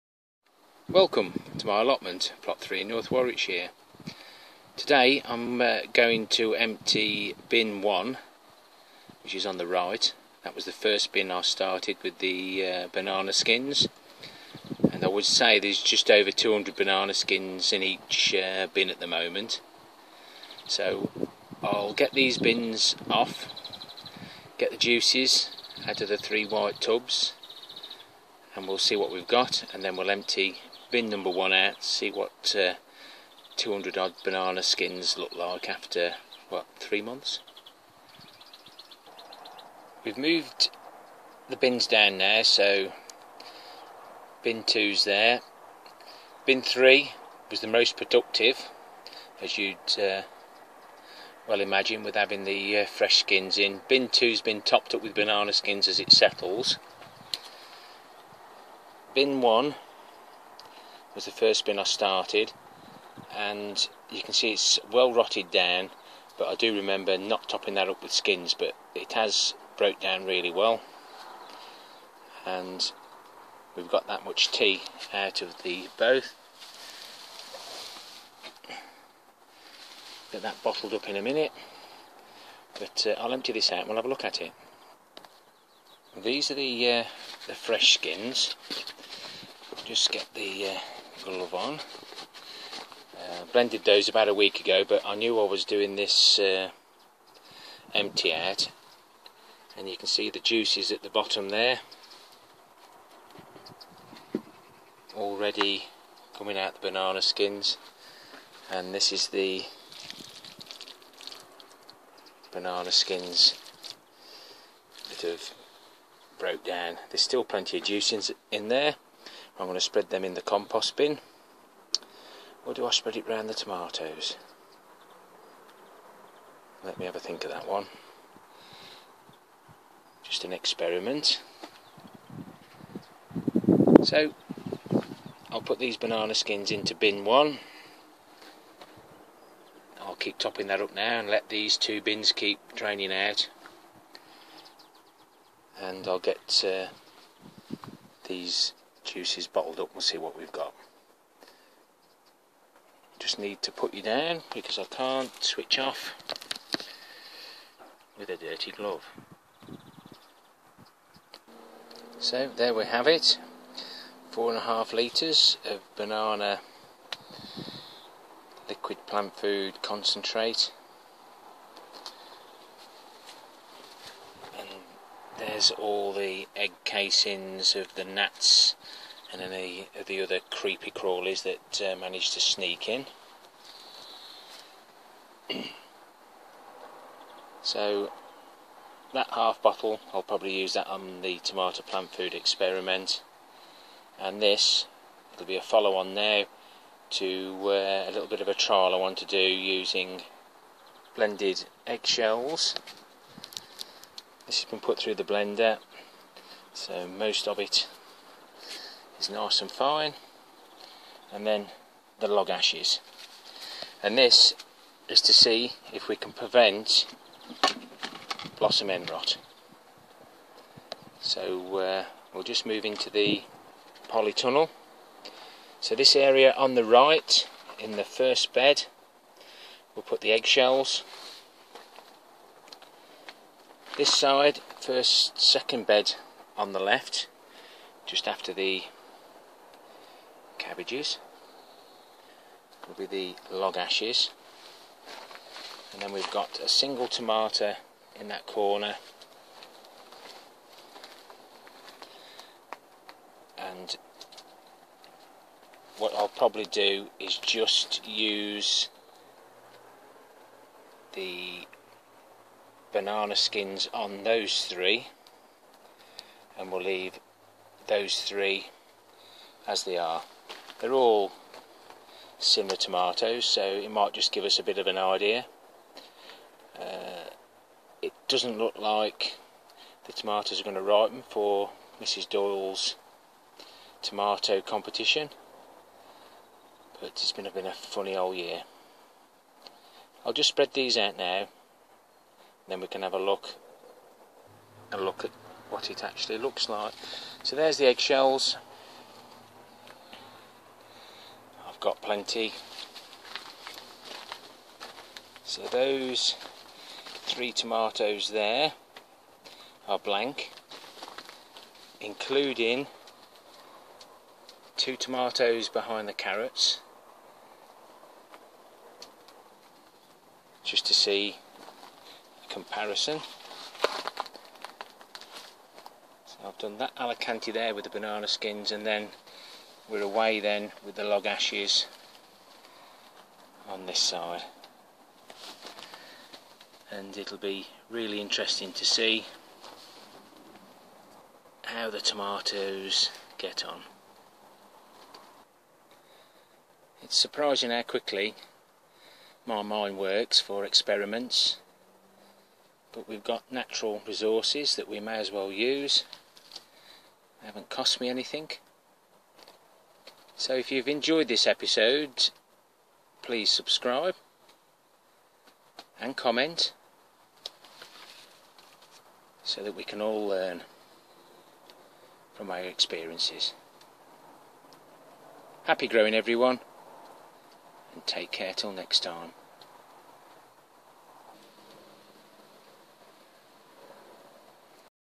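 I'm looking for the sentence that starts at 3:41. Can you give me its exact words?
So uh, we'll just move into the polytunnel.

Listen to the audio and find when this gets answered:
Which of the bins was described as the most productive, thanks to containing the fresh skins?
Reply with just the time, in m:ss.
0:46.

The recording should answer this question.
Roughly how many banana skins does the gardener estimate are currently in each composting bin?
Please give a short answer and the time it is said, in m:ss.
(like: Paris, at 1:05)
Just over 200, at 0:15.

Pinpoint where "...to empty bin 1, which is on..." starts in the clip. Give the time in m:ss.
0:06.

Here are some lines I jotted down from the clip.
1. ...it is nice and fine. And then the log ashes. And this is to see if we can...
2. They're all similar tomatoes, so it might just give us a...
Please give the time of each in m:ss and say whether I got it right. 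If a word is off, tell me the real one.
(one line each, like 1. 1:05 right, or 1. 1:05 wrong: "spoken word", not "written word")
1. 3:27 right
2. 4:30 right.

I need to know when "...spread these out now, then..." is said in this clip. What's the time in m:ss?
4:50.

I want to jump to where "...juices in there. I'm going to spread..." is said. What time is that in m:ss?
1:57.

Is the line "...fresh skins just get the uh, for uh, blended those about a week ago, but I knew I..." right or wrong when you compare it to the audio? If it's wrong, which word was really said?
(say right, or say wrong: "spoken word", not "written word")
right.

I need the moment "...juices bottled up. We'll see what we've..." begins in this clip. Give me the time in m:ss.
2:29.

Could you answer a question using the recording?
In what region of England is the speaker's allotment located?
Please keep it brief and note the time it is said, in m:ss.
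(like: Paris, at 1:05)
North Warwickshire, at 0:02.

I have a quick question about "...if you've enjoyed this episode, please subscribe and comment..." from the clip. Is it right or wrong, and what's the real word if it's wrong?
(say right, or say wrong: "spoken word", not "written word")
right.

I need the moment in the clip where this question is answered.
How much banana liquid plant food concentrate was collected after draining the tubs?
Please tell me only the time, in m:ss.
2:44.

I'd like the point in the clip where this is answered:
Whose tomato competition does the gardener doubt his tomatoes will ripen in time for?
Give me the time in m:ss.
4:42.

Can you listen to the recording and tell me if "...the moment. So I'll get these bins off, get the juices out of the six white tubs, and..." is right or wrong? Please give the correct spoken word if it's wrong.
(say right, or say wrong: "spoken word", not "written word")
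wrong: "three", not "six".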